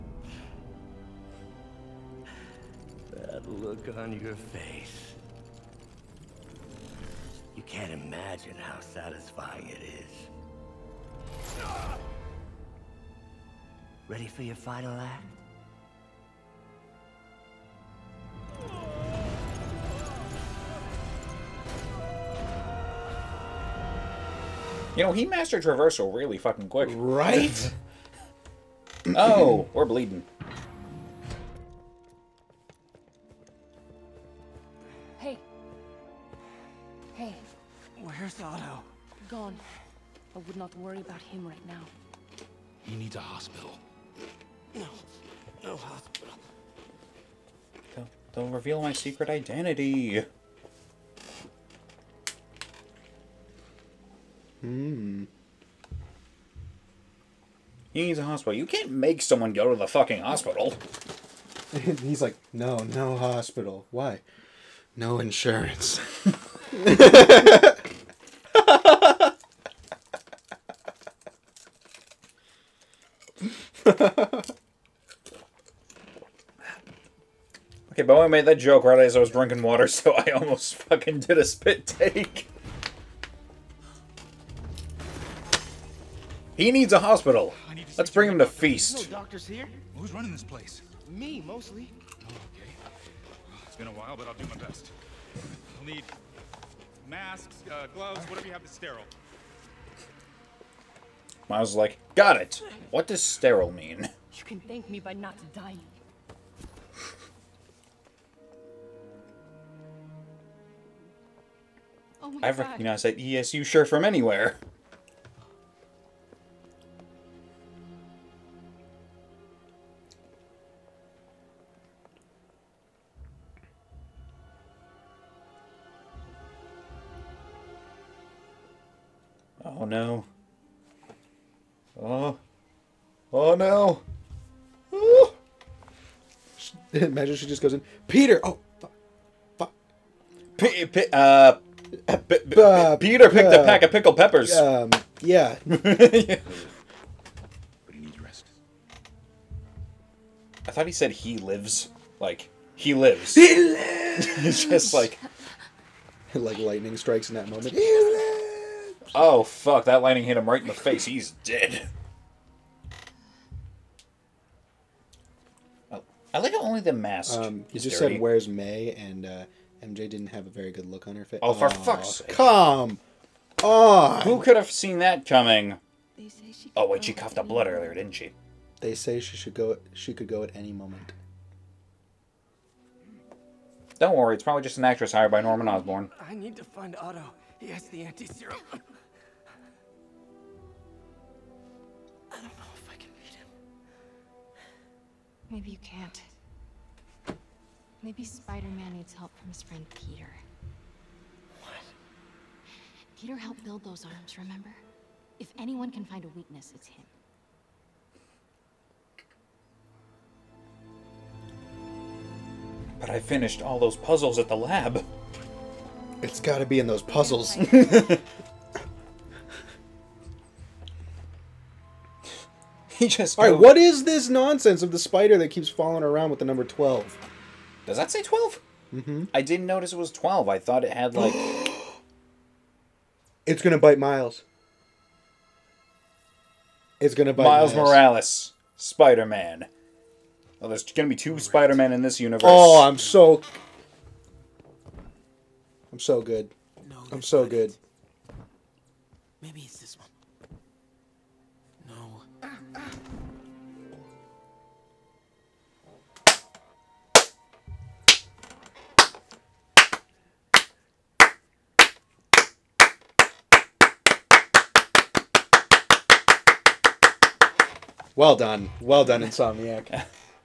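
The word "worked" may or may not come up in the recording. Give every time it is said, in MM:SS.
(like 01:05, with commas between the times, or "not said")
not said.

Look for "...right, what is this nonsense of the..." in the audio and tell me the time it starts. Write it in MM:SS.
03:43.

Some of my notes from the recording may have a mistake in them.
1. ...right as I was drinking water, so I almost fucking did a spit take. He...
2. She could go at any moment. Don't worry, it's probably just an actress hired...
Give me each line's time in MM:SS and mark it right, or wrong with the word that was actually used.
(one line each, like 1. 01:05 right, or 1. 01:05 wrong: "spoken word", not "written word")
1. 01:18 right
2. 02:59 right.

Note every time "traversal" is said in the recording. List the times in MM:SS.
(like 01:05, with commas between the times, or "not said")
00:25.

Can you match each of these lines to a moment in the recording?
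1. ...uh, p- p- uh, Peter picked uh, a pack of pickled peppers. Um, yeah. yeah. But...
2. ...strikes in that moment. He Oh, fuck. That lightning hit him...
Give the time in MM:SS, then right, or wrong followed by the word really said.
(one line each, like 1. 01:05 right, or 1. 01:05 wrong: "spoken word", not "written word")
1. 02:21 right
2. 02:36 right.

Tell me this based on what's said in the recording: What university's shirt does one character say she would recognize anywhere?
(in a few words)
ESU.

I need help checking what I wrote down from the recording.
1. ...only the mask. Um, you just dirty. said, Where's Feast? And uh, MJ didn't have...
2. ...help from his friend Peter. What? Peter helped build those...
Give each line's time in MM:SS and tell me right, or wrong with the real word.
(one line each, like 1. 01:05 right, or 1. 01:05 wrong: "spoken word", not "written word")
1. 02:46 wrong: "May", not "Feast"
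2. 03:19 right.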